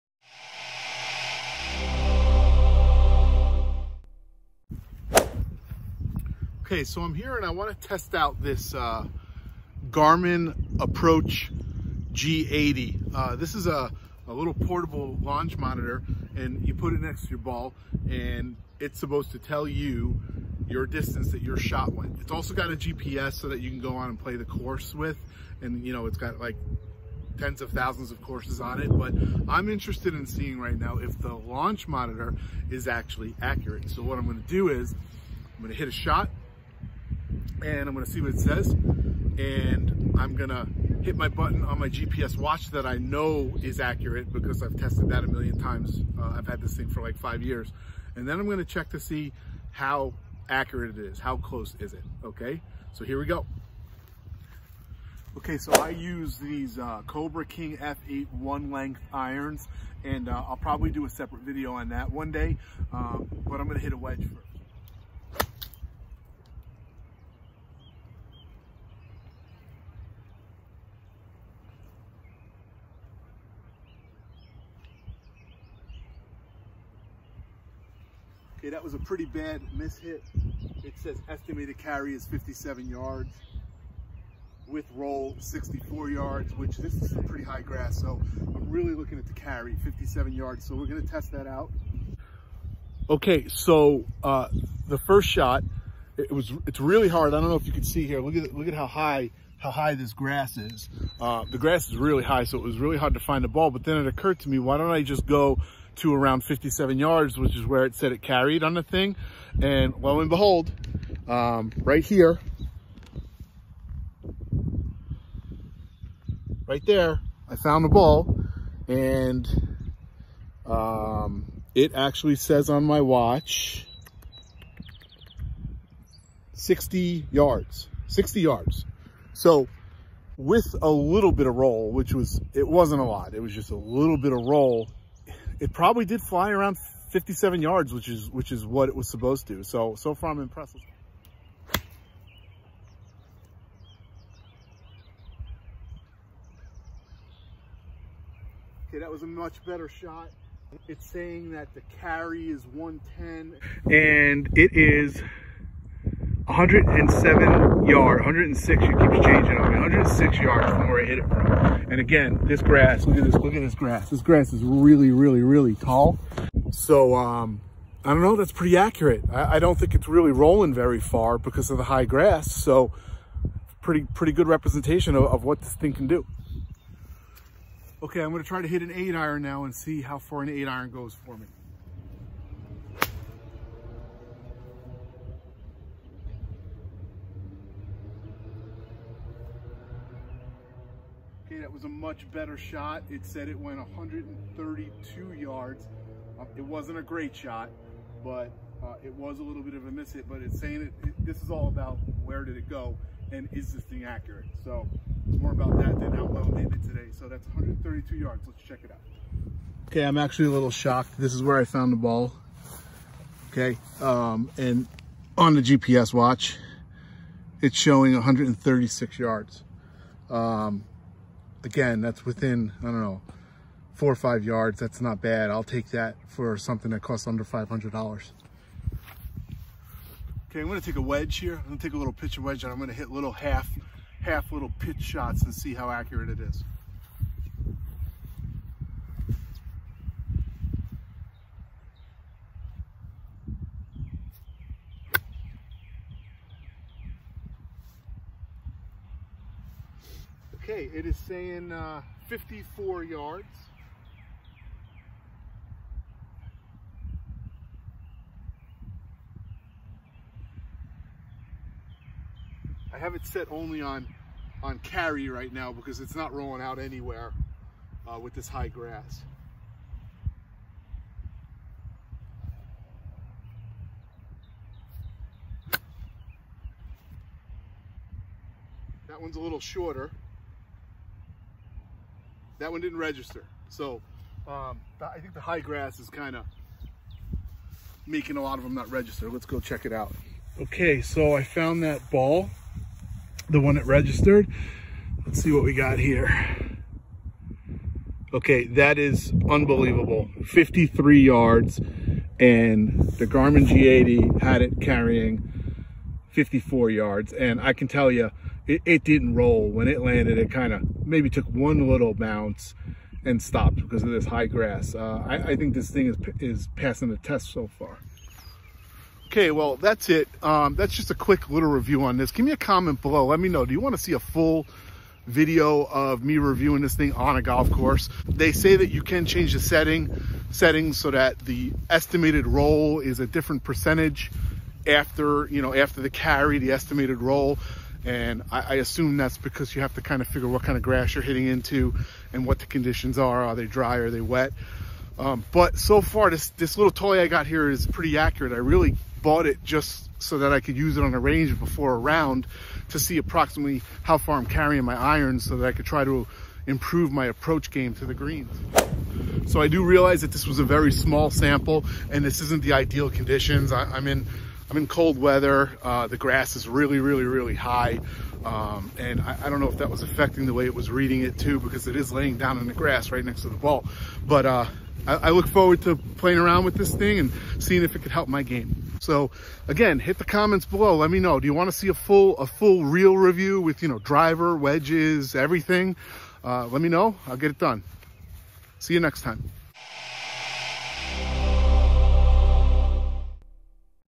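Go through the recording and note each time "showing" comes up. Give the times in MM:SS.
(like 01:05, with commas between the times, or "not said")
03:37.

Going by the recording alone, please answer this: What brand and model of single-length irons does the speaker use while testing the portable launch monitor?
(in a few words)
Cobra King F8.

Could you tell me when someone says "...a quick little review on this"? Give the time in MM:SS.
05:21.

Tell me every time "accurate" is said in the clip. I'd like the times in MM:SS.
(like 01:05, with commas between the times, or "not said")
00:33, 00:43, 00:50, 02:48, 03:24, 03:55, 05:48.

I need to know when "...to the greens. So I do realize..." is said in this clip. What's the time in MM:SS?
05:57.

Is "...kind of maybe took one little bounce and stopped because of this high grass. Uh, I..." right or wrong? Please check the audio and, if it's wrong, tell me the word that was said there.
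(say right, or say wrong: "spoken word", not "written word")
right.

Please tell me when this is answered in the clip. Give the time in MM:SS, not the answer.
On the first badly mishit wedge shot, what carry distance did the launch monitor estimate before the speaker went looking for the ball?
01:21.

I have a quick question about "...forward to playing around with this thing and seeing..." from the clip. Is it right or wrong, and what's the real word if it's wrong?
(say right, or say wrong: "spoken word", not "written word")
right.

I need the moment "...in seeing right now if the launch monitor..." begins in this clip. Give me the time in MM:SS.
00:30.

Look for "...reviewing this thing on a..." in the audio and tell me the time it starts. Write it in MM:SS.
05:26.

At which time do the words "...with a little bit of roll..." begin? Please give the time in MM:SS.
02:10.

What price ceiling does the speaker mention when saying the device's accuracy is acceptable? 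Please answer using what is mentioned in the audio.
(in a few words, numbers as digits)
under $500.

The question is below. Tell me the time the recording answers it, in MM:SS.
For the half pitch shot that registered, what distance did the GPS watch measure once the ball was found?
05:00.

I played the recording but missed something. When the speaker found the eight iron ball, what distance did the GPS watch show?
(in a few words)
136 yards.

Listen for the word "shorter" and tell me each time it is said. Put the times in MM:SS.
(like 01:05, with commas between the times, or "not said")
04:39.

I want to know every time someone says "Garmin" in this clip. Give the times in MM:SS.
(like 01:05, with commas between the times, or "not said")
00:09, 05:03.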